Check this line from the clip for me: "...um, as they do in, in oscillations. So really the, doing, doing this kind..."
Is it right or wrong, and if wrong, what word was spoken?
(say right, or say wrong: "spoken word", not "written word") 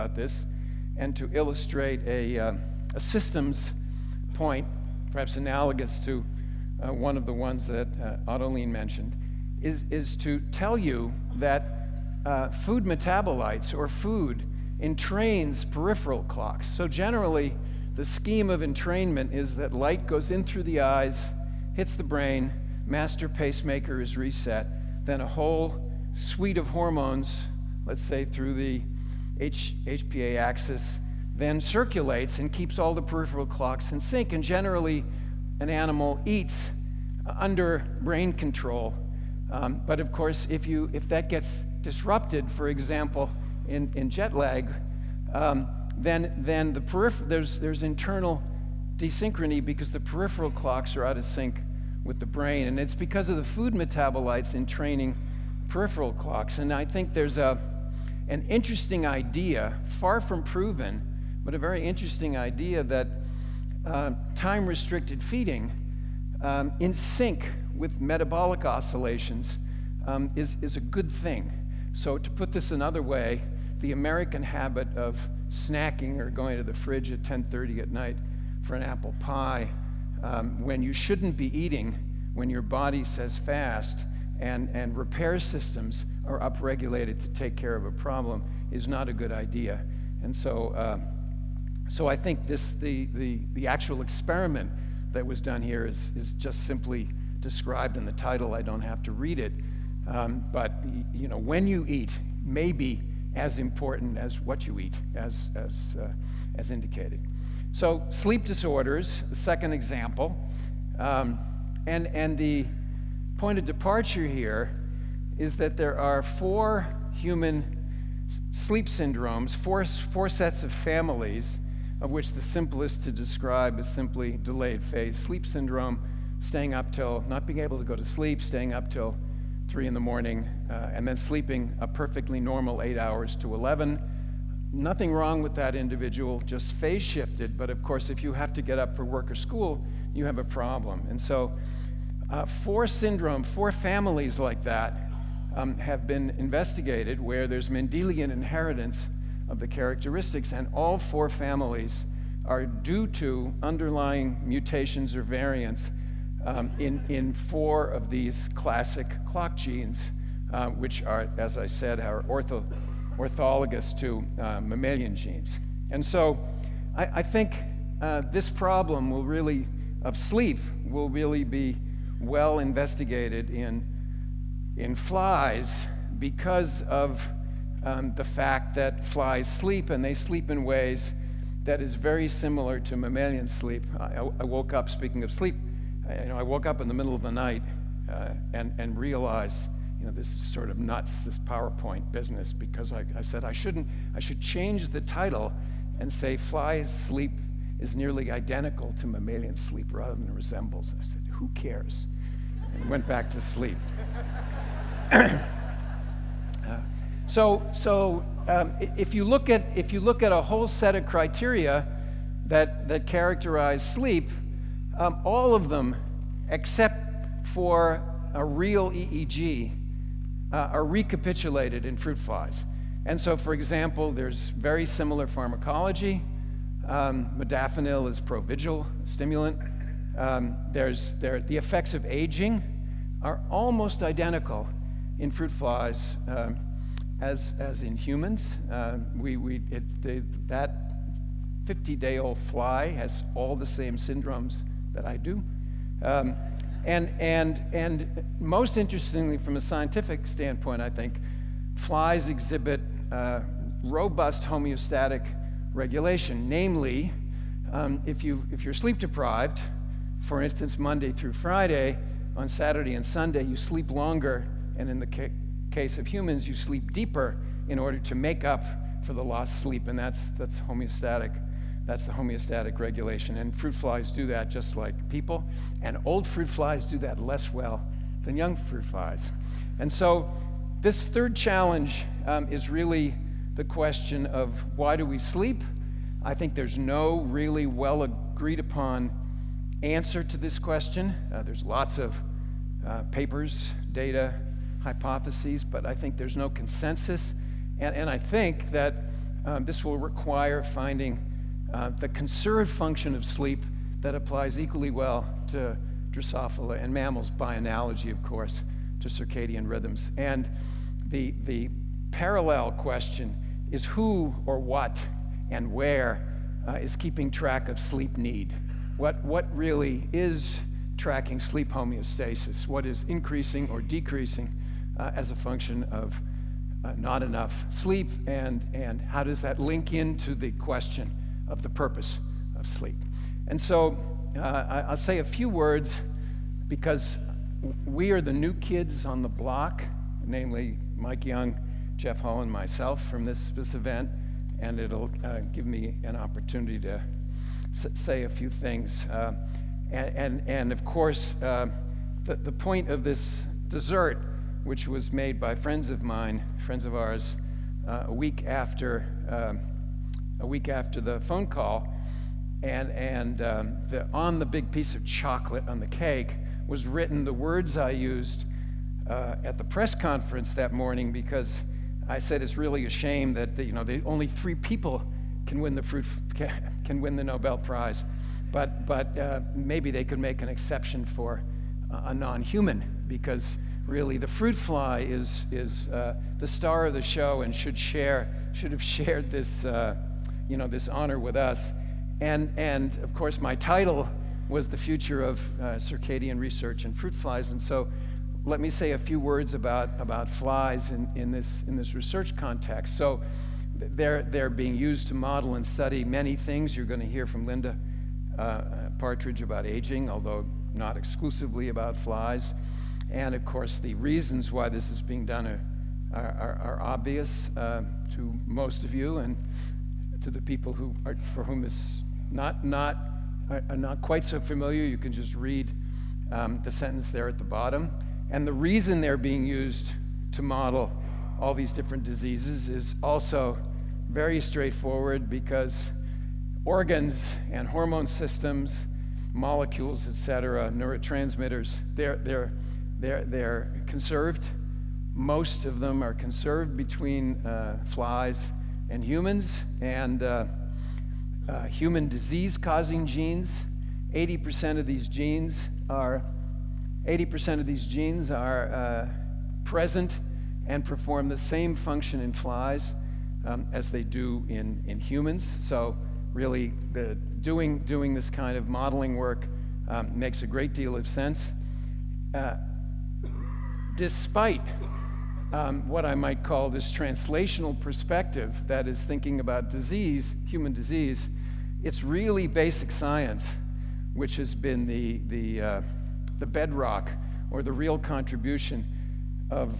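wrong: "humans", not "oscillations".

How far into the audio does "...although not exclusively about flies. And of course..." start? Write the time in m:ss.
6:50.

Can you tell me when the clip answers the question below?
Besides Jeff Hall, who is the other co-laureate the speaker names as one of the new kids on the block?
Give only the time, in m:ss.
5:40.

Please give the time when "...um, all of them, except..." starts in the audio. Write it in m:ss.
3:34.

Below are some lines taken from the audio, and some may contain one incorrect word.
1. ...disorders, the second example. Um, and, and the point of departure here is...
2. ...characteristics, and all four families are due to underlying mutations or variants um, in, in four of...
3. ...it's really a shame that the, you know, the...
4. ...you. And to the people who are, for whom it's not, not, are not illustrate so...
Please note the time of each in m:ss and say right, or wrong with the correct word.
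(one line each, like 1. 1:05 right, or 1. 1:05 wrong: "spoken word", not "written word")
1. 1:48 right
2. 2:29 right
3. 6:12 right
4. 6:58 wrong: "quite", not "illustrate".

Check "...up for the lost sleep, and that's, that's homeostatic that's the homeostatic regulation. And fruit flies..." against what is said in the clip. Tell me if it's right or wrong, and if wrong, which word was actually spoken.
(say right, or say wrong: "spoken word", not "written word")
right.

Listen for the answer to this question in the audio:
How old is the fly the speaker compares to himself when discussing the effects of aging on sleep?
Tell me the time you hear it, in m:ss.
4:01.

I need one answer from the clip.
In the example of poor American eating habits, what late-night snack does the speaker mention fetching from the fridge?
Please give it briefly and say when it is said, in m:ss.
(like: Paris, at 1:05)
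apple pie, at 1:18.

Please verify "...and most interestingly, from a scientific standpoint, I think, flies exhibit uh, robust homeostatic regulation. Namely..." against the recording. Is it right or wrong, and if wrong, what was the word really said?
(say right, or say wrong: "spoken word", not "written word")
right.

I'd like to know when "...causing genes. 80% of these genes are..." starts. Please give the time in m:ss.
7:32.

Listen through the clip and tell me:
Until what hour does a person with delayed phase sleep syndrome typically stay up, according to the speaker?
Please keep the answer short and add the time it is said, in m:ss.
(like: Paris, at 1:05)
3 in the morning, at 2:09.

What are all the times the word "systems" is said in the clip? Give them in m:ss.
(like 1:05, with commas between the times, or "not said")
0:02, 1:25, 7:18.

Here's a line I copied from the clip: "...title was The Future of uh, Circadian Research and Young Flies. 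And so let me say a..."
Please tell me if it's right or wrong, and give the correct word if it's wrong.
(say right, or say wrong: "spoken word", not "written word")
wrong: "Fruit", not "Young".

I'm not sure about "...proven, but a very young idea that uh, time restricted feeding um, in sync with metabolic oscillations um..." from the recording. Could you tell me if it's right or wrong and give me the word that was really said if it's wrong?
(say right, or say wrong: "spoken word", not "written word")
wrong: "interesting", not "young".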